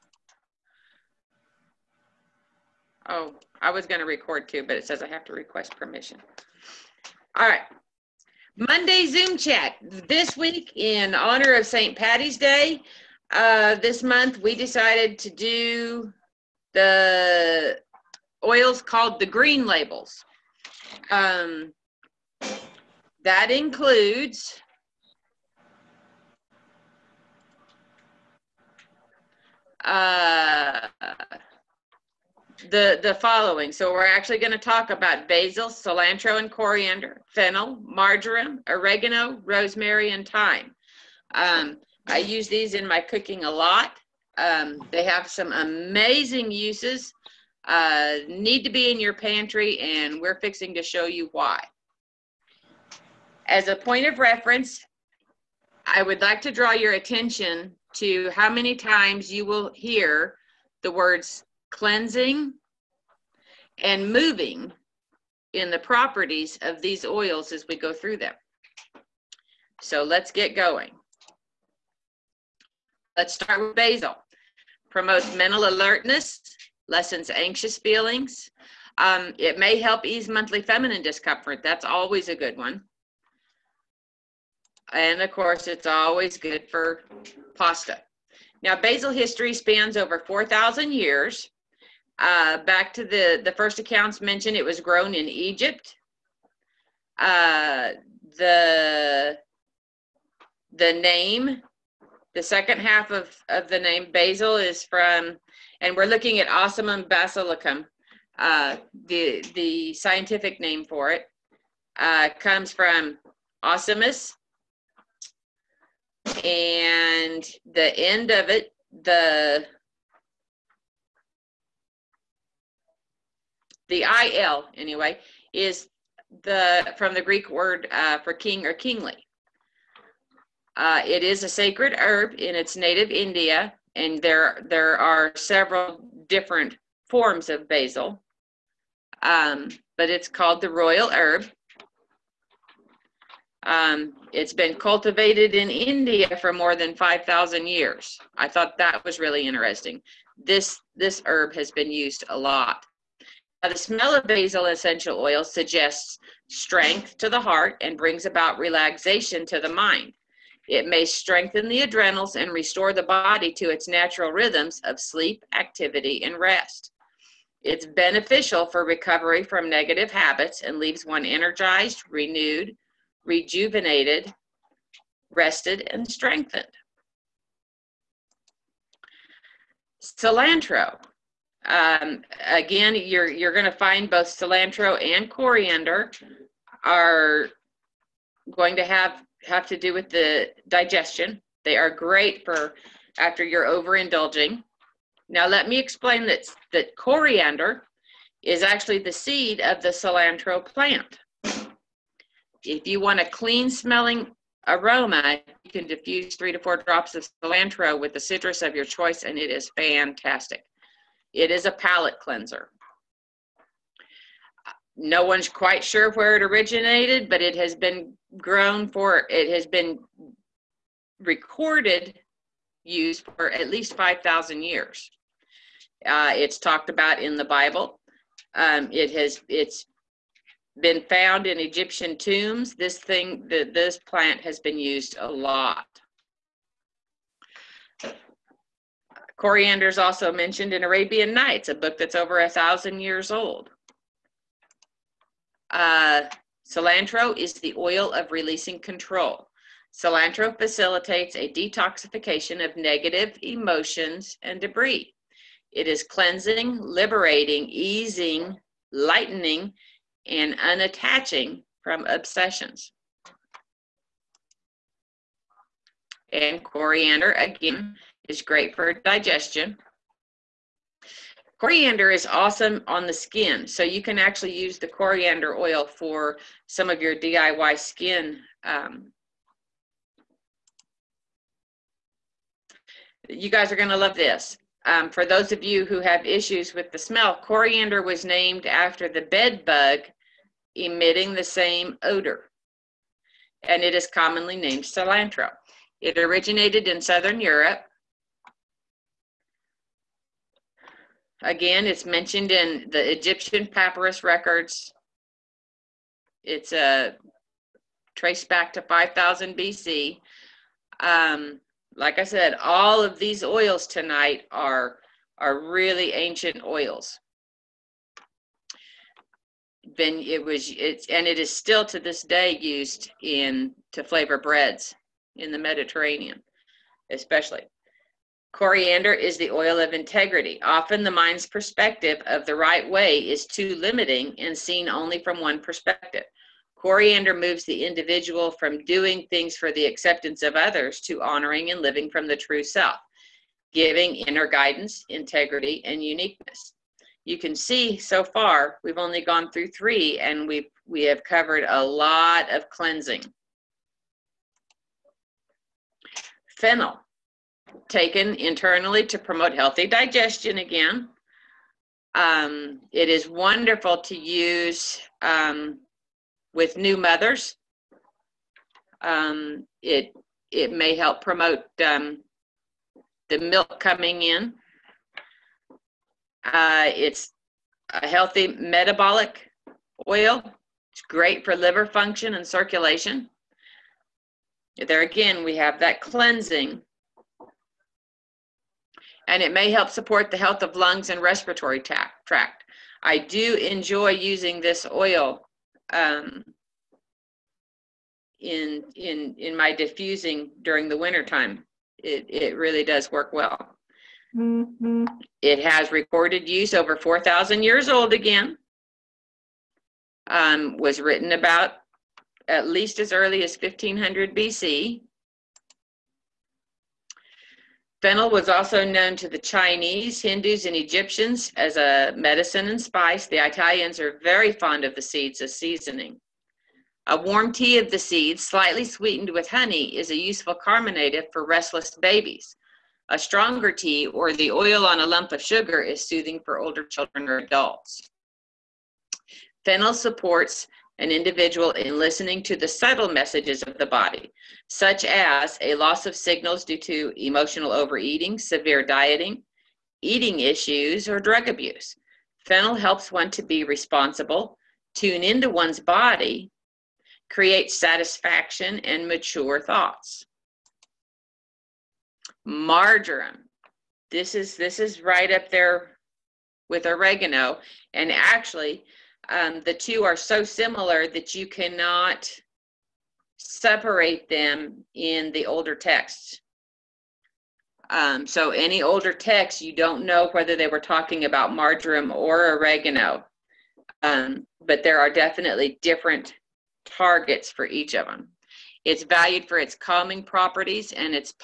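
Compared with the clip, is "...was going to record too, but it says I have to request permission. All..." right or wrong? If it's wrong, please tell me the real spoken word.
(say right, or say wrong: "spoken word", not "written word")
right.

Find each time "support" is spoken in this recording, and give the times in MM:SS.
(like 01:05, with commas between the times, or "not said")
06:29, 07:19.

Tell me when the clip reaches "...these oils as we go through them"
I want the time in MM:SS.
01:06.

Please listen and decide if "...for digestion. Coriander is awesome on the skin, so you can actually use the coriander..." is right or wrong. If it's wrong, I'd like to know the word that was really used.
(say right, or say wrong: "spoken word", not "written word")
right.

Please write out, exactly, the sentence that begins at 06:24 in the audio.
There again, we have that cleansing.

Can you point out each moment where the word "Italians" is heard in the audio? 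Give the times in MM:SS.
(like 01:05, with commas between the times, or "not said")
07:03.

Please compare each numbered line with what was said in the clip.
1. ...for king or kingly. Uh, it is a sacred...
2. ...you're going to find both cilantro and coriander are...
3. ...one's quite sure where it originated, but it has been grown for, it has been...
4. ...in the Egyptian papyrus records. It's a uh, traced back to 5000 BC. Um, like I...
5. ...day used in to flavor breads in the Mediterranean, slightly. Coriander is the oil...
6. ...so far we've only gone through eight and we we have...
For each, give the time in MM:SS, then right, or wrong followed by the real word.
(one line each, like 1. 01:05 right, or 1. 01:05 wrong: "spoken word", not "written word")
1. 02:08 right
2. 03:03 right
3. 03:35 right
4. 05:02 right
5. 05:22 wrong: "especially", not "slightly"
6. 05:47 wrong: "three", not "eight".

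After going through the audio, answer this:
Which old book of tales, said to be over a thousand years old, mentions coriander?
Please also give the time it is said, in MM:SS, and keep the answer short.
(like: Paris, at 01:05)
Arabian Nights, at 04:00.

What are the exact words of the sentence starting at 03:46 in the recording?
Uh, it's talked about in the Bible.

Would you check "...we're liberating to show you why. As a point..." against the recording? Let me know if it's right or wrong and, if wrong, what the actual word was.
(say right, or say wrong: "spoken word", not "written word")
wrong: "fixing", not "liberating".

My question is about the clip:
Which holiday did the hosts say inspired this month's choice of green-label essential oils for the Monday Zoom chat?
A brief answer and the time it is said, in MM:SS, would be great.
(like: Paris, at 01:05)
St. Patty's Day, at 00:11.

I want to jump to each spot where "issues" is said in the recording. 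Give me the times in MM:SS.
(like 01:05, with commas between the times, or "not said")
04:46, 07:30.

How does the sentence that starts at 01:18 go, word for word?
Um, it may help ease monthly feminine discomfort.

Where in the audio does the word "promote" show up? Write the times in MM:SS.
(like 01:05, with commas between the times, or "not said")
01:14, 05:59, 06:11.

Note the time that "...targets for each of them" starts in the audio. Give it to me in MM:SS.
08:06.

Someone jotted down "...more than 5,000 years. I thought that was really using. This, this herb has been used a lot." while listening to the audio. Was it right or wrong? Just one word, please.
wrong.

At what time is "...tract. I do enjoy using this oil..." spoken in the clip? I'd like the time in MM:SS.
06:31.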